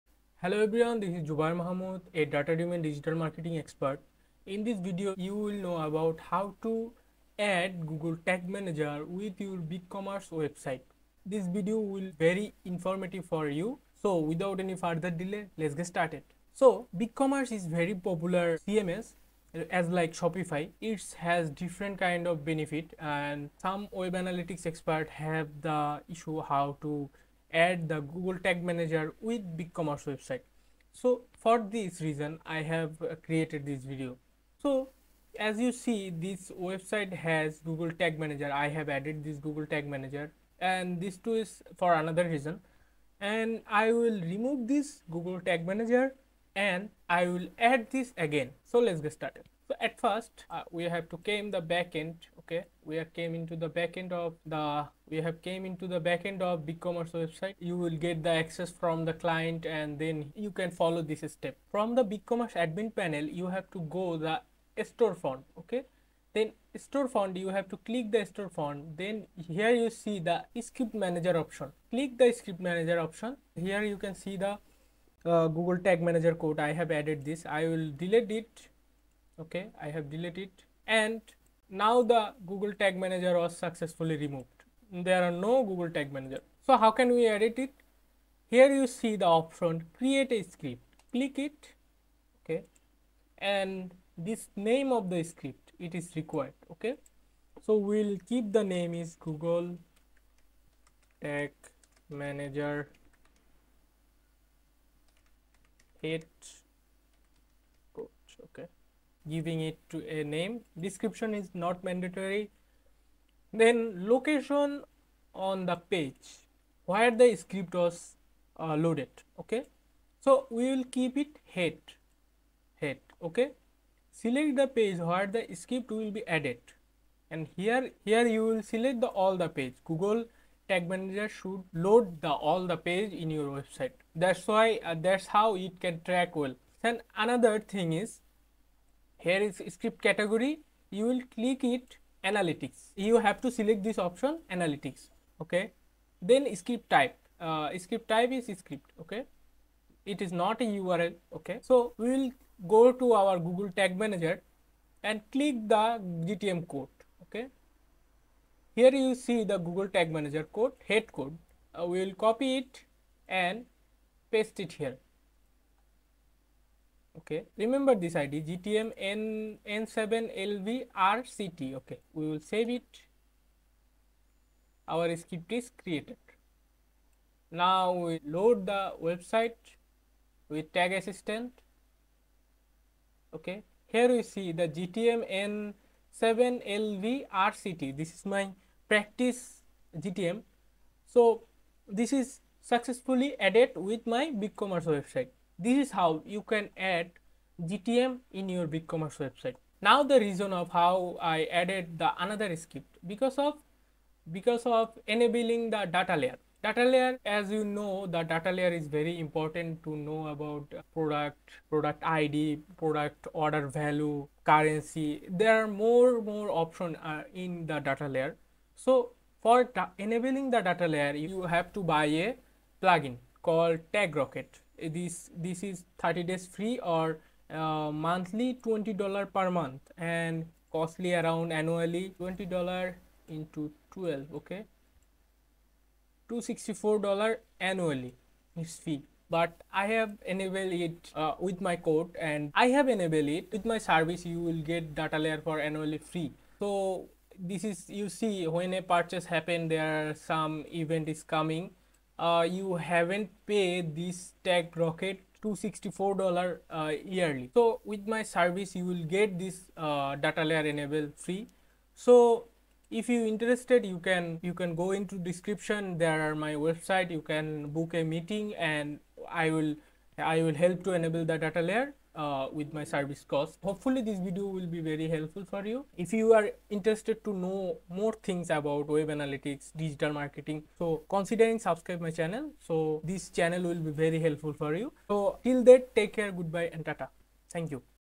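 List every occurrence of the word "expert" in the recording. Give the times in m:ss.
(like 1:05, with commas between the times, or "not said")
0:03, 0:24.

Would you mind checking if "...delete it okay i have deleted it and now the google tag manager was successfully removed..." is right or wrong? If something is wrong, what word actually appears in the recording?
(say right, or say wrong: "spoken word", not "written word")
right.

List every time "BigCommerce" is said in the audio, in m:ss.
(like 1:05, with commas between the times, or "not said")
0:09, 0:16, 0:29, 0:56, 1:02, 3:14, 3:18.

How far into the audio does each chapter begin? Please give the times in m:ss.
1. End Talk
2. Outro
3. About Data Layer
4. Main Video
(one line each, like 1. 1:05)
1. 3:44
2. 4:33
3. 3:20
4. 0:16.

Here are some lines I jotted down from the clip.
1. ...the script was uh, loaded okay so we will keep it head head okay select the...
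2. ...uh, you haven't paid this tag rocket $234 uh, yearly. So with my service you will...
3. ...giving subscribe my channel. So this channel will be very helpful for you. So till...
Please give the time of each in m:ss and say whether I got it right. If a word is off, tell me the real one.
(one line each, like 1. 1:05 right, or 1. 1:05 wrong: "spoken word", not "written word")
1. 1:57 right
2. 4:12 wrong: "264", not "234"
3. 4:41 wrong: "considering", not "giving".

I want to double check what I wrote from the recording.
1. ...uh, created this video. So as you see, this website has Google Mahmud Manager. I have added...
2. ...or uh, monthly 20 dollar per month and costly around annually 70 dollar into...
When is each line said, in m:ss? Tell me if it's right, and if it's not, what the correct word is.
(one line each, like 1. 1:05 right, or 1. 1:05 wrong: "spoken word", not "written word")
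1. 0:33 wrong: "Tag", not "Mahmud"
2. 3:46 wrong: "20", not "70".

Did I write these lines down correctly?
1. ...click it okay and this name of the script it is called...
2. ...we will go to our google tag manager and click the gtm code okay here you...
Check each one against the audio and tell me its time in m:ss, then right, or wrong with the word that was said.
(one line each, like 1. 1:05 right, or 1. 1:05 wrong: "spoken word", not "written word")
1. 1:31 wrong: "required", not "called"
2. 2:31 right.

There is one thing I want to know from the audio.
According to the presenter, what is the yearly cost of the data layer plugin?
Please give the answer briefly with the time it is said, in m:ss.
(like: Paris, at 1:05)
$264, at 3:56.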